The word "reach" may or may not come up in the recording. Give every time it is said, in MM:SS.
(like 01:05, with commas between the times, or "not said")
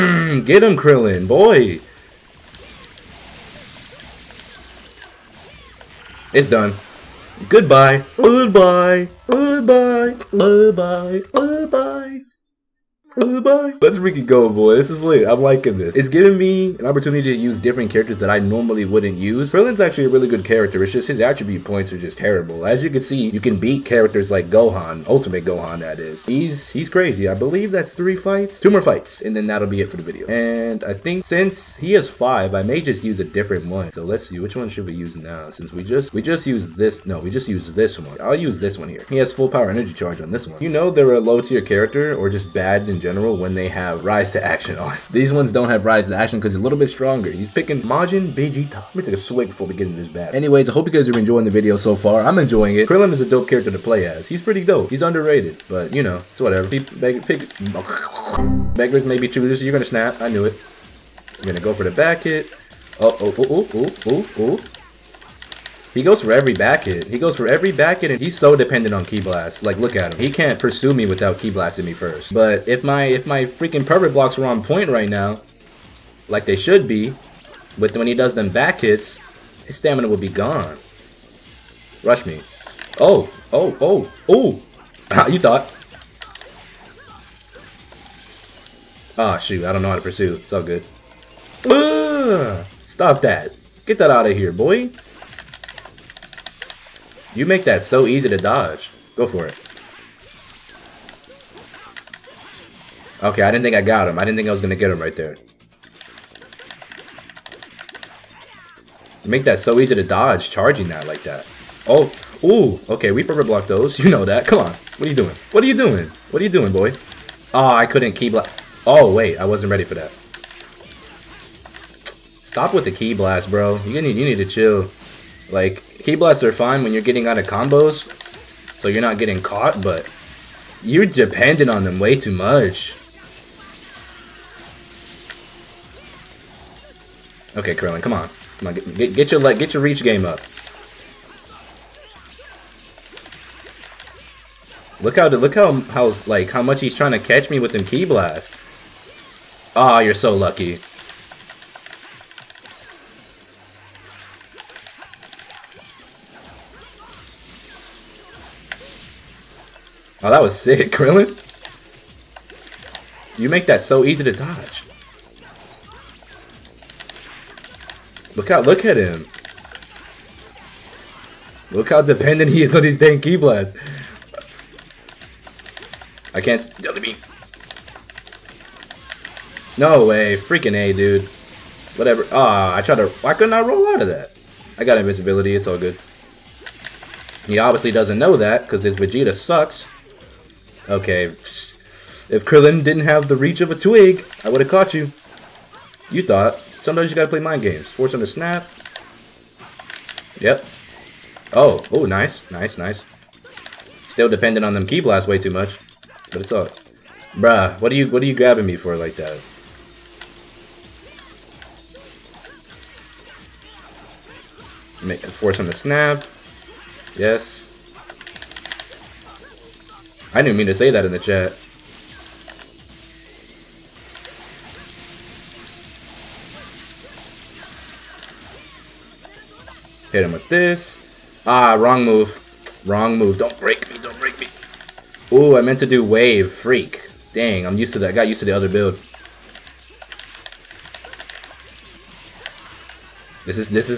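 02:19, 03:13.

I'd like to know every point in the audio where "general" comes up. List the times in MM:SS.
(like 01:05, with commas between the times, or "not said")
00:43.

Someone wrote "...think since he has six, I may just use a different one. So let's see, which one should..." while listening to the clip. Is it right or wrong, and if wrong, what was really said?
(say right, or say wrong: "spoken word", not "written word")
wrong: "five", not "six".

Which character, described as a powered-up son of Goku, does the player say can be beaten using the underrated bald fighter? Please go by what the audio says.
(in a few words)
Ultimate Gohan.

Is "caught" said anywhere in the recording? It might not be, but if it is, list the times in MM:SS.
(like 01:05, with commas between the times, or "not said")
02:09, 03:14.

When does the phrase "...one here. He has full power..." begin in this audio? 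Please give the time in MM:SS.
00:38.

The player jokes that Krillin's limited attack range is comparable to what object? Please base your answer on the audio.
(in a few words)
A twig.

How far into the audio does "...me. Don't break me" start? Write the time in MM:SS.
03:53.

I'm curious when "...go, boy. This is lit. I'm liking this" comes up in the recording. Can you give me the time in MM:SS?
00:14.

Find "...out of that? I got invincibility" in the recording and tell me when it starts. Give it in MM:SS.
03:03.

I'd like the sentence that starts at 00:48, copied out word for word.
Let me take a swig before we get into this battle.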